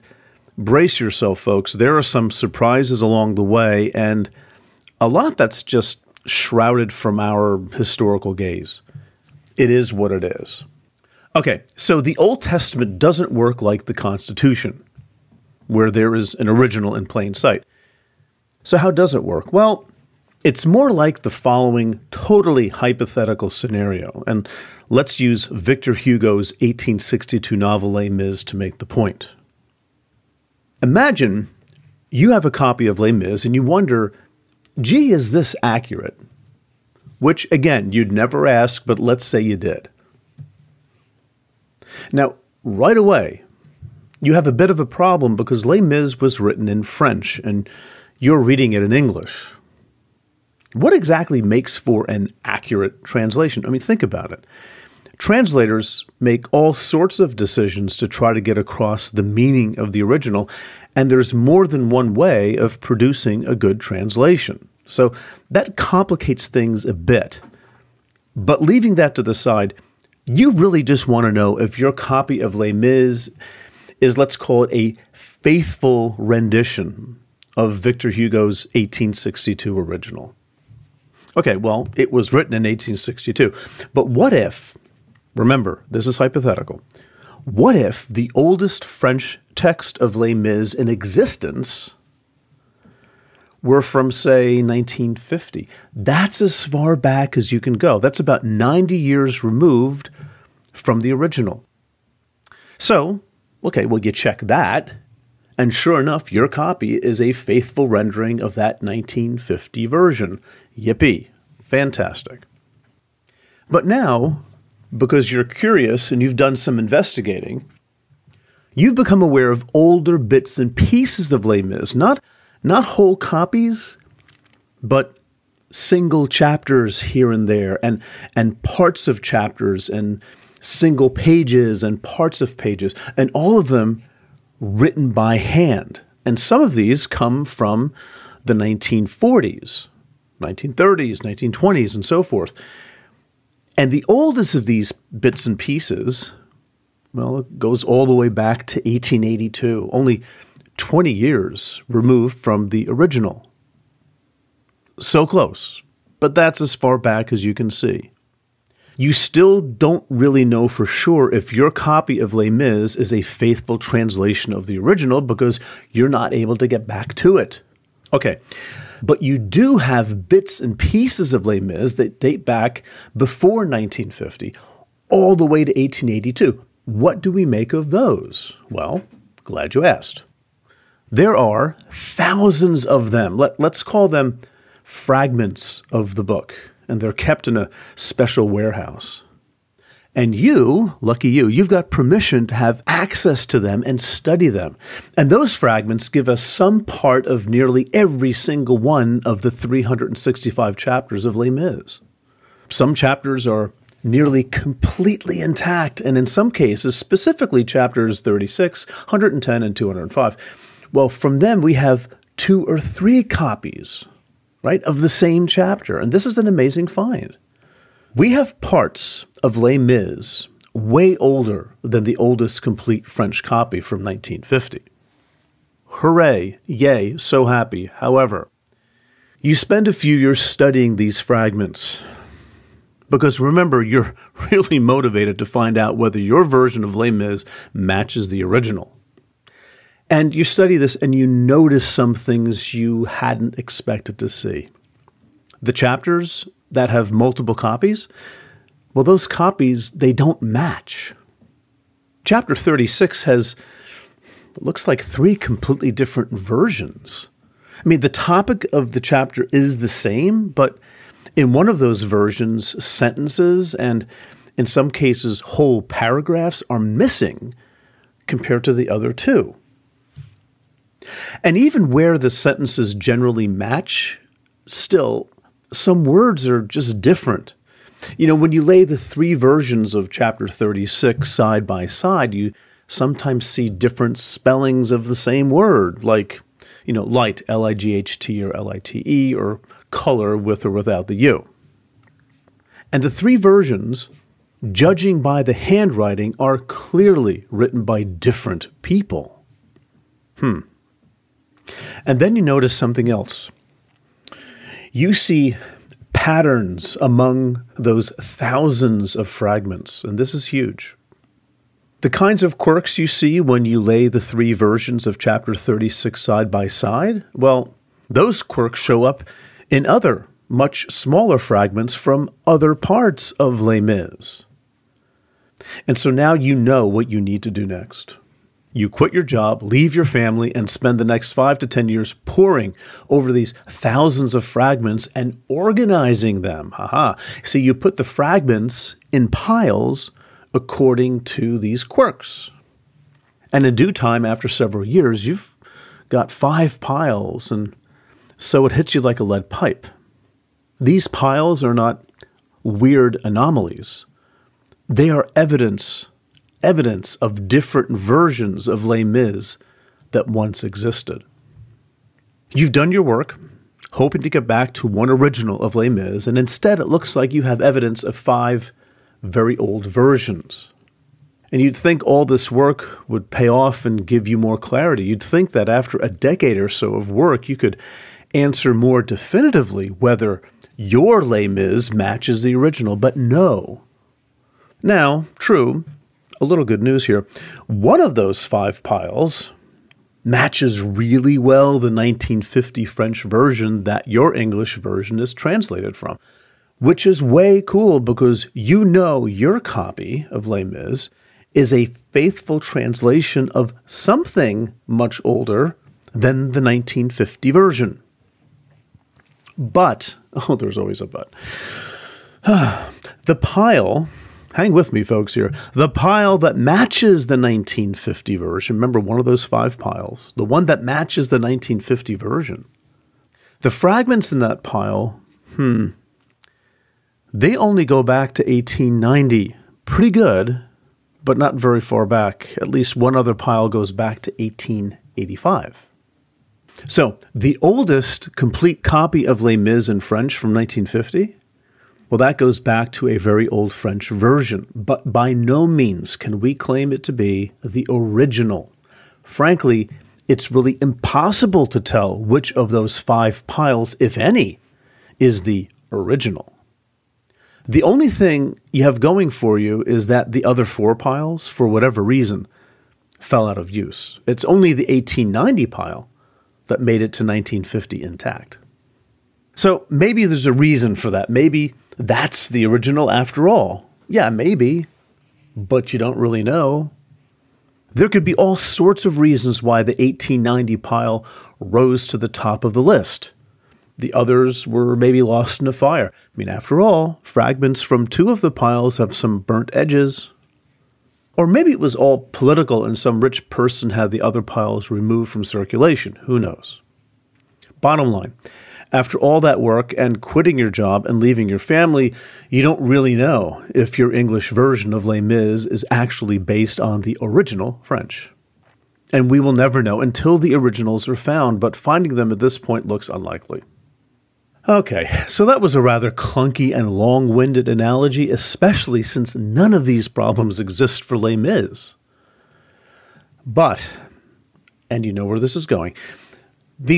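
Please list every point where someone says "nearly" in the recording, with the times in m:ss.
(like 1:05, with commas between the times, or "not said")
3:17, 3:24.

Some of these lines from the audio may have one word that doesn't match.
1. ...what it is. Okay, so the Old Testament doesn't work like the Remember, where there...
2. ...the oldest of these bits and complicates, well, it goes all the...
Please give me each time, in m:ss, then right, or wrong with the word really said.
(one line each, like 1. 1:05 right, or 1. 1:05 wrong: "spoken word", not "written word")
1. 0:09 wrong: "Constitution", not "Remember"
2. 2:23 wrong: "pieces", not "complicates".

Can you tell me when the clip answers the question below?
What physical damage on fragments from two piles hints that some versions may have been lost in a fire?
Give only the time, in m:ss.
8:09.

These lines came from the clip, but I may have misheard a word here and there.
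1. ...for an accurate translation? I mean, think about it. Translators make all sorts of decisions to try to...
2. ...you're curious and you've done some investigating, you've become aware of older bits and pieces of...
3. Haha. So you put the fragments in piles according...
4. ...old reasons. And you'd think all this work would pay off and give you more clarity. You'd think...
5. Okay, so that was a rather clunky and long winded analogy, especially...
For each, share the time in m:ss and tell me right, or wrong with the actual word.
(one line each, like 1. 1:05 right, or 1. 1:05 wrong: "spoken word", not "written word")
1. 0:51 right
2. 1:55 right
3. 5:36 right
4. 6:09 wrong: "versions", not "reasons"
5. 8:34 right.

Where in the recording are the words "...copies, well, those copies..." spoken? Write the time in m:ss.
4:07.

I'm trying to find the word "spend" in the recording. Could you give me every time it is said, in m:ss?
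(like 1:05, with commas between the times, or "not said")
3:49, 5:30.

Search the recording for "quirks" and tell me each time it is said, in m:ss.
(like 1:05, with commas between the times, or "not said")
5:12, 5:18, 5:41.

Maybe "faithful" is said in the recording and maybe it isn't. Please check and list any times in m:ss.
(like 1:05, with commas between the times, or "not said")
1:15, 1:47, 2:43, 6:42.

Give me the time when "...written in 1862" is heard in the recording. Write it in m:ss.
1:22.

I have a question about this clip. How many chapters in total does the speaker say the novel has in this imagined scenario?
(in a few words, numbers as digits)
365.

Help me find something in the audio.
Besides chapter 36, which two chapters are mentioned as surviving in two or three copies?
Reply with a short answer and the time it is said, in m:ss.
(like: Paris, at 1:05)
110 and 205, at 3:28.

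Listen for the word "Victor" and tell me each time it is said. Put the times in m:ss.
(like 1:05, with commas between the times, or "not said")
0:25, 1:17.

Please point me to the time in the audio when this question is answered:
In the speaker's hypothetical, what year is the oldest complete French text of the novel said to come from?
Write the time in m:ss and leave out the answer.
1:34.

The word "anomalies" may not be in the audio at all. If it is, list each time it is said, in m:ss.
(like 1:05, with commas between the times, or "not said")
5:53.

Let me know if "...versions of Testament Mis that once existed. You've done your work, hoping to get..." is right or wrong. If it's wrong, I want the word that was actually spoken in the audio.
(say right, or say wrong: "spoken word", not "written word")
wrong: "Les", not "Testament".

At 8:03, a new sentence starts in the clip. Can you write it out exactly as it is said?
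The others were maybe lost in a fire.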